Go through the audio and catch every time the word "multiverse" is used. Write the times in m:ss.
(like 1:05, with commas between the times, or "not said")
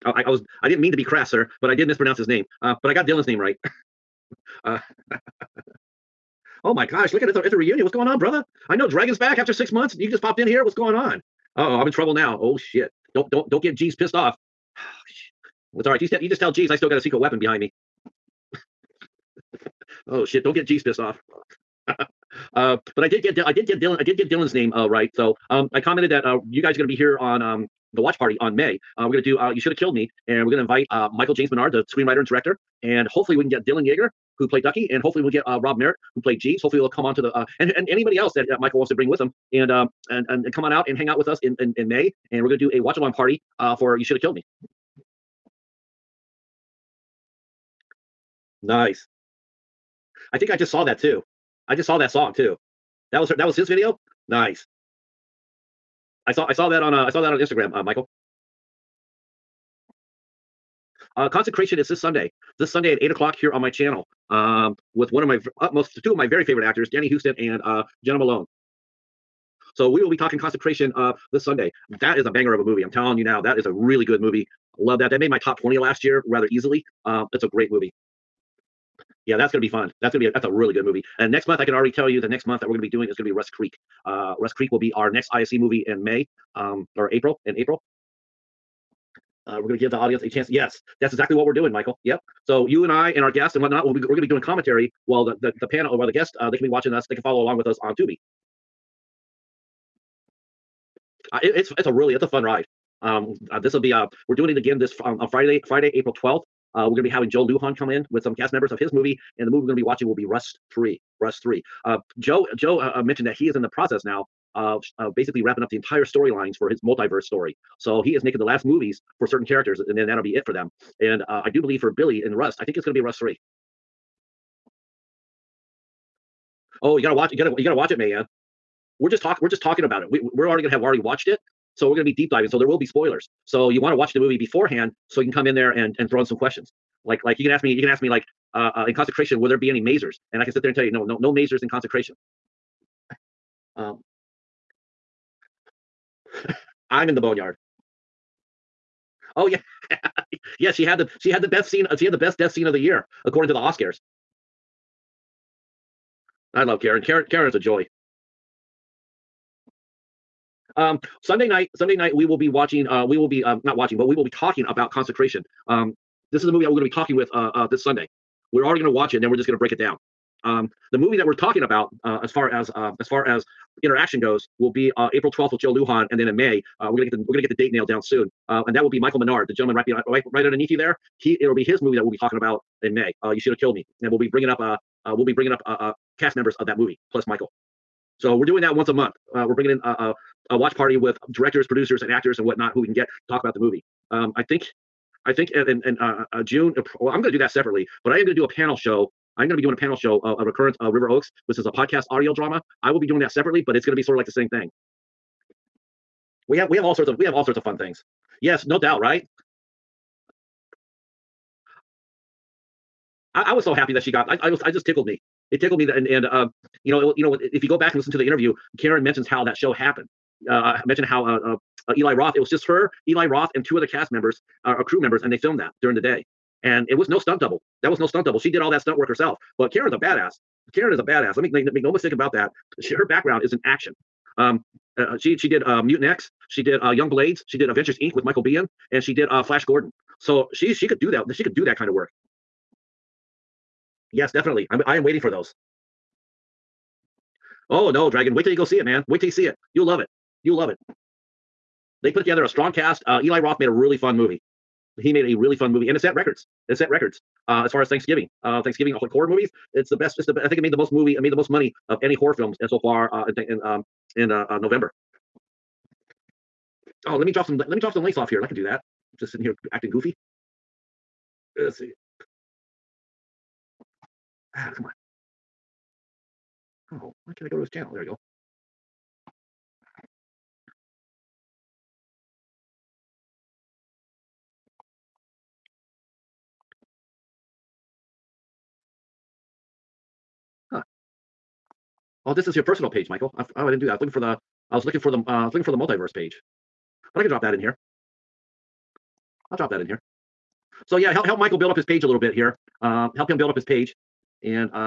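1:56, 4:55.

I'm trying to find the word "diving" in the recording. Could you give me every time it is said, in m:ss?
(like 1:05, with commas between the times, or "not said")
2:12.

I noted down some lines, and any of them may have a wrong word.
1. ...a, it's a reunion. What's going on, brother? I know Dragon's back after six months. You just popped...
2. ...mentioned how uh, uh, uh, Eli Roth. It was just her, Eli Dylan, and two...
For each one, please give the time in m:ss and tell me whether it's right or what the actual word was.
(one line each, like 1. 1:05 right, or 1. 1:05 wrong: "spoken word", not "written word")
1. 0:07 right
2. 3:40 wrong: "Roth", not "Dylan".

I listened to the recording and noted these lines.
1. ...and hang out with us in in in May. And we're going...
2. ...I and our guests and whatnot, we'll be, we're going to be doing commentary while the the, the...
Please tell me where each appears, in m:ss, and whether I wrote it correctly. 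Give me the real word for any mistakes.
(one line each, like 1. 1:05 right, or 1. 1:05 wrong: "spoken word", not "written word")
1. 0:40 right
2. 1:32 right.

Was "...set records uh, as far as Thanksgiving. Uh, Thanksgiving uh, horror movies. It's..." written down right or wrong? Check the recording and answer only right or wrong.
right.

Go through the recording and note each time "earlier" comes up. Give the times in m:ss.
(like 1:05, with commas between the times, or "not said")
not said.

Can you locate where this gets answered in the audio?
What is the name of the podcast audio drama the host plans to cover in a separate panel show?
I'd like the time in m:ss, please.
3:20.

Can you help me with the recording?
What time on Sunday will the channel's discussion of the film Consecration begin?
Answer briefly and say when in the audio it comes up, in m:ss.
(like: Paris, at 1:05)
eight o'clock, at 1:03.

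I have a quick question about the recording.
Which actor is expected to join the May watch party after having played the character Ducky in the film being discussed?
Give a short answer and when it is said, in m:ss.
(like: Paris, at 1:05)
Dylan Yeager, at 0:33.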